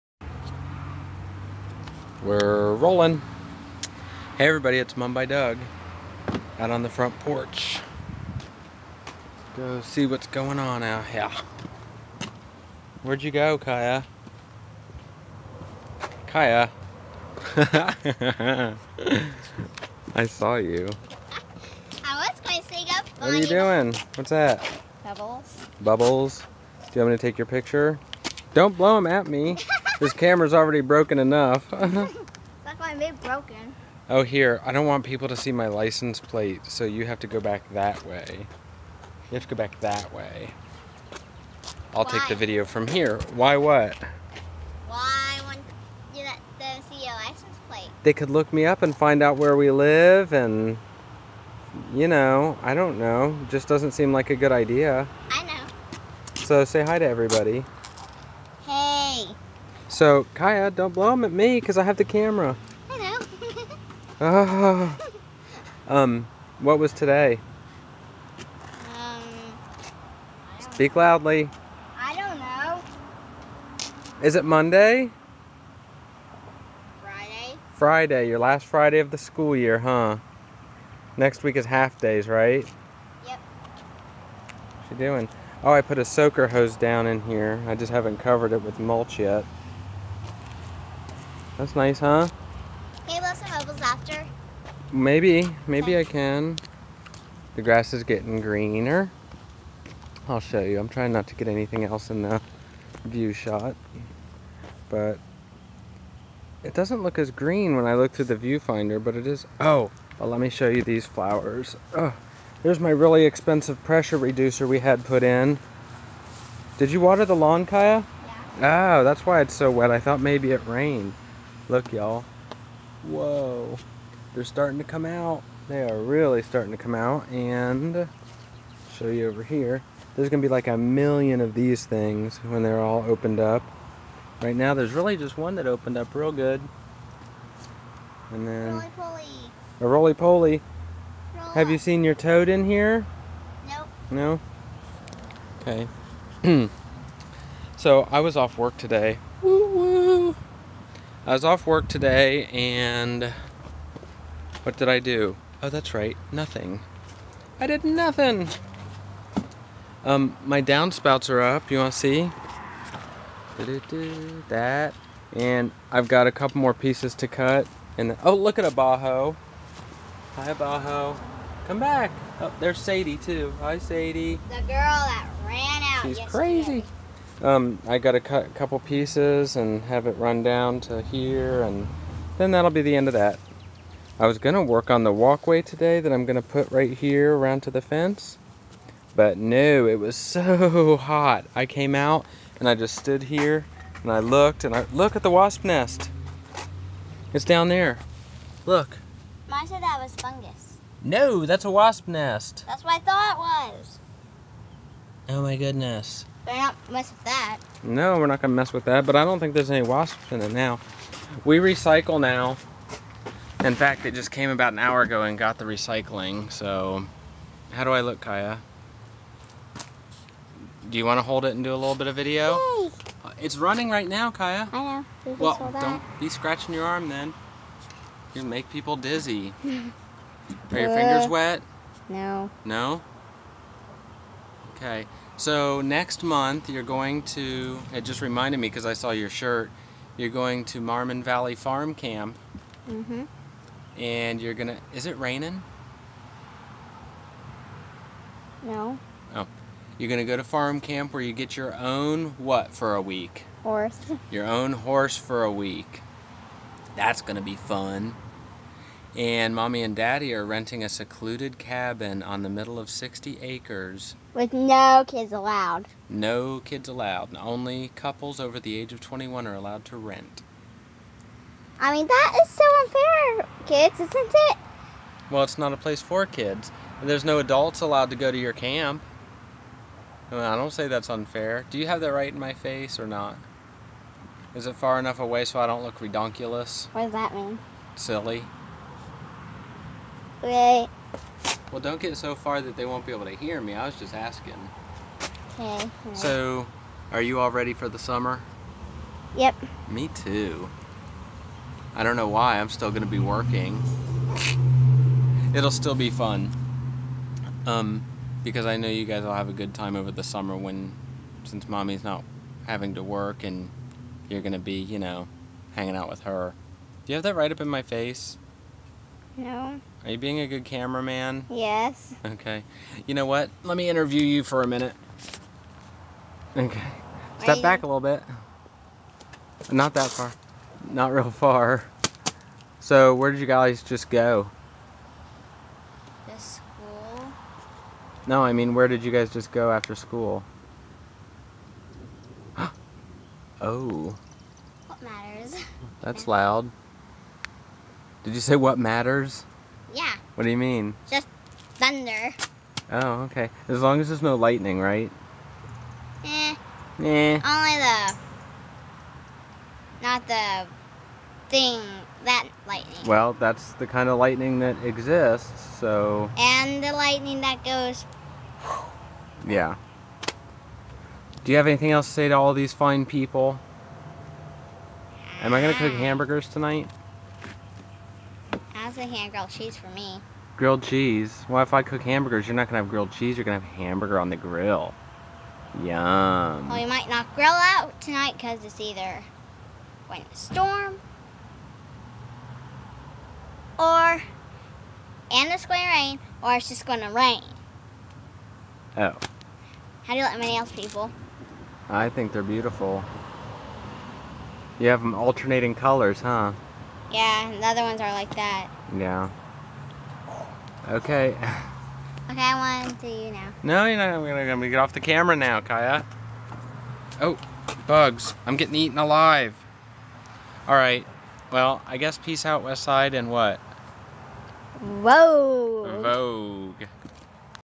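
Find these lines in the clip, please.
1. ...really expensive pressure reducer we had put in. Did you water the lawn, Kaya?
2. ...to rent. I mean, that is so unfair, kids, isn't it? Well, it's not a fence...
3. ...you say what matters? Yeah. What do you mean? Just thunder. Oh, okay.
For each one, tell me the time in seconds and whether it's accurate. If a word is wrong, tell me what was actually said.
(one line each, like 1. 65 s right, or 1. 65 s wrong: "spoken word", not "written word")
1. 112 s right
2. 269 s wrong: "place", not "fence"
3. 348 s right.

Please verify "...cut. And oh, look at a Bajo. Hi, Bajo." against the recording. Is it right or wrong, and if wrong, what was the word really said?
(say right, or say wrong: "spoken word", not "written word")
right.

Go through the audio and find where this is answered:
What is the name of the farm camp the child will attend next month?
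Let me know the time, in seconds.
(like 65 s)
240 s.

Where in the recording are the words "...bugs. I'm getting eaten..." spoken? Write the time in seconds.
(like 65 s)
417 s.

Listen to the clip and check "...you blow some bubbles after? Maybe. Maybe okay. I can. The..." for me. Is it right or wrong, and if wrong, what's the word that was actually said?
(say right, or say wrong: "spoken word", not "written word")
right.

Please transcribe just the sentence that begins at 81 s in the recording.
Next week is half days, right?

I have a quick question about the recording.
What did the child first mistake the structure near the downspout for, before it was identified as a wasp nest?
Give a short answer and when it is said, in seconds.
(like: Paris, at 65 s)
Fungus, at 200 s.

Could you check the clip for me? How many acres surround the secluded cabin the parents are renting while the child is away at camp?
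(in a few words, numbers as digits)
60.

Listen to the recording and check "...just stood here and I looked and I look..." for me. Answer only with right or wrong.
right.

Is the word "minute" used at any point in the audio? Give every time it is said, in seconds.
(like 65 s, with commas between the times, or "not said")
324 s.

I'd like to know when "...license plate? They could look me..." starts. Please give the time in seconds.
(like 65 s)
47 s.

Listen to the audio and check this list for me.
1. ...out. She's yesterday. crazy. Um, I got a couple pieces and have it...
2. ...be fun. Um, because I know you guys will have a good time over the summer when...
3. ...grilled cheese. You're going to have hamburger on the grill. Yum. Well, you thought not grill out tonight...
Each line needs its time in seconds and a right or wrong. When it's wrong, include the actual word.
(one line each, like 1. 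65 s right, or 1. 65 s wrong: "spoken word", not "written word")
1. 175 s right
2. 305 s right
3. 382 s wrong: "might", not "thought".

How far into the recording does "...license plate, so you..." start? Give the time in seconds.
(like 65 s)
35 s.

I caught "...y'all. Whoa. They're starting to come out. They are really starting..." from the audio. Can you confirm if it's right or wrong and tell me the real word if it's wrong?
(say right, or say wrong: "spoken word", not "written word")
right.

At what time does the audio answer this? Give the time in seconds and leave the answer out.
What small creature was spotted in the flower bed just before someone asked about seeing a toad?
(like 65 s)
139 s.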